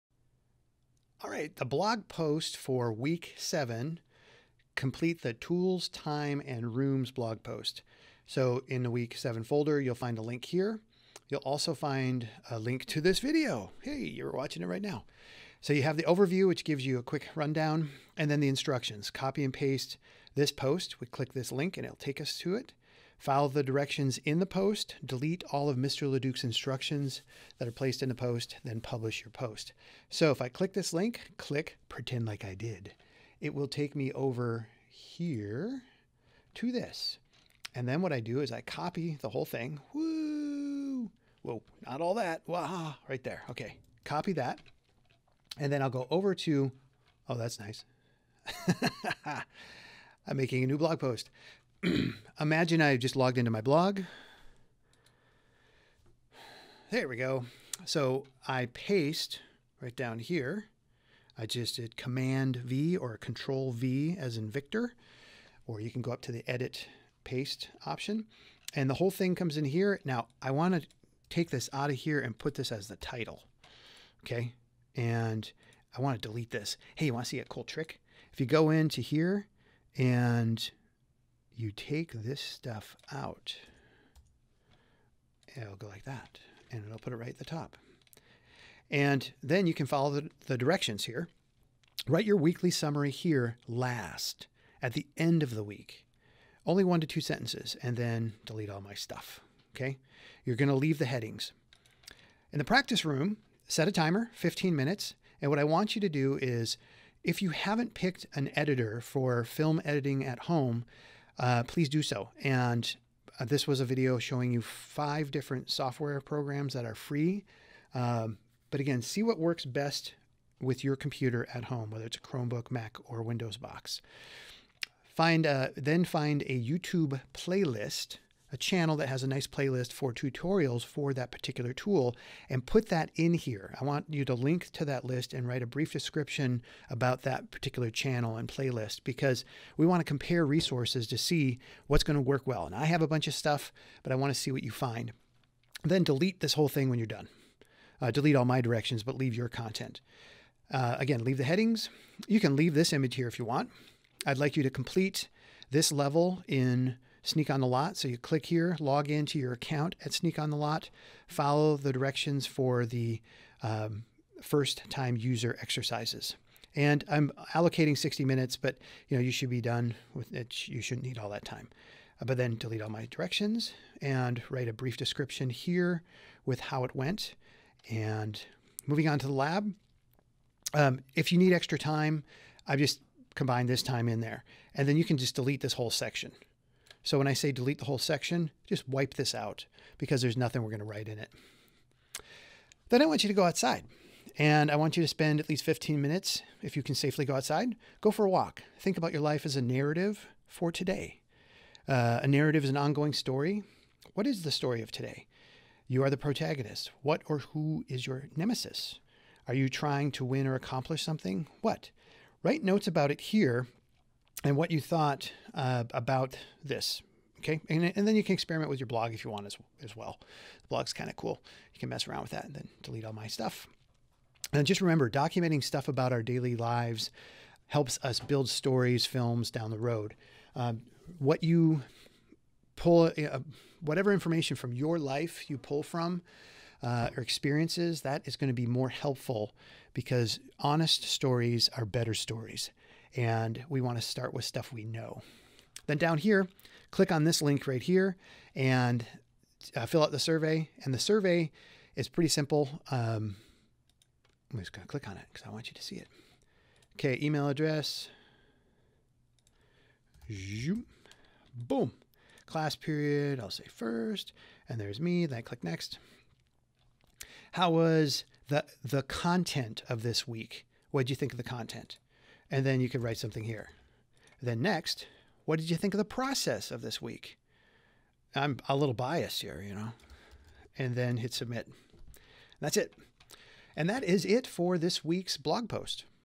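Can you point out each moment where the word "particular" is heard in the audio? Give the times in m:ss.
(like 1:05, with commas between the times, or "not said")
2:11, 2:17.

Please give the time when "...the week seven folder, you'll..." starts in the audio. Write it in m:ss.
0:08.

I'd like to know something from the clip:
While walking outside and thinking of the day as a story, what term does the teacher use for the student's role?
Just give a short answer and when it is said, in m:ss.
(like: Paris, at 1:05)
protagonist, at 3:26.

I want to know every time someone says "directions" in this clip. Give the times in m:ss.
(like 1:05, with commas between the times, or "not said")
0:23, 1:30, 2:28, 2:41, 2:53.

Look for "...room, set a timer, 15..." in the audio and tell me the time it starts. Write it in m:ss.
1:43.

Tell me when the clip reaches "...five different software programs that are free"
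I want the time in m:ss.
1:54.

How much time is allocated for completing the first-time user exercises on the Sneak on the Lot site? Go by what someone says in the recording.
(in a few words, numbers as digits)
60 minutes.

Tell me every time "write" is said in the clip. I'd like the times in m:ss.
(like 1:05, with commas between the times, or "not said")
1:32, 2:15, 2:54, 3:10, 3:32, 4:33.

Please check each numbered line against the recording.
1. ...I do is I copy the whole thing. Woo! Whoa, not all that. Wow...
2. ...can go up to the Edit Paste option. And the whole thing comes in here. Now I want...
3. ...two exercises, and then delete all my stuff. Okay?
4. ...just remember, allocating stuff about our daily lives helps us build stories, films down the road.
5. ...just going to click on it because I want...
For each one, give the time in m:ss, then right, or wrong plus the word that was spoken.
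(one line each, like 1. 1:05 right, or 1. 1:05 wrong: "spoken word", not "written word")
1. 0:38 right
2. 1:05 right
3. 1:37 wrong: "sentences", not "exercises"
4. 3:44 wrong: "documenting", not "allocating"
5. 4:14 right.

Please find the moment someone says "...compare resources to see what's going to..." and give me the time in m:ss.
2:20.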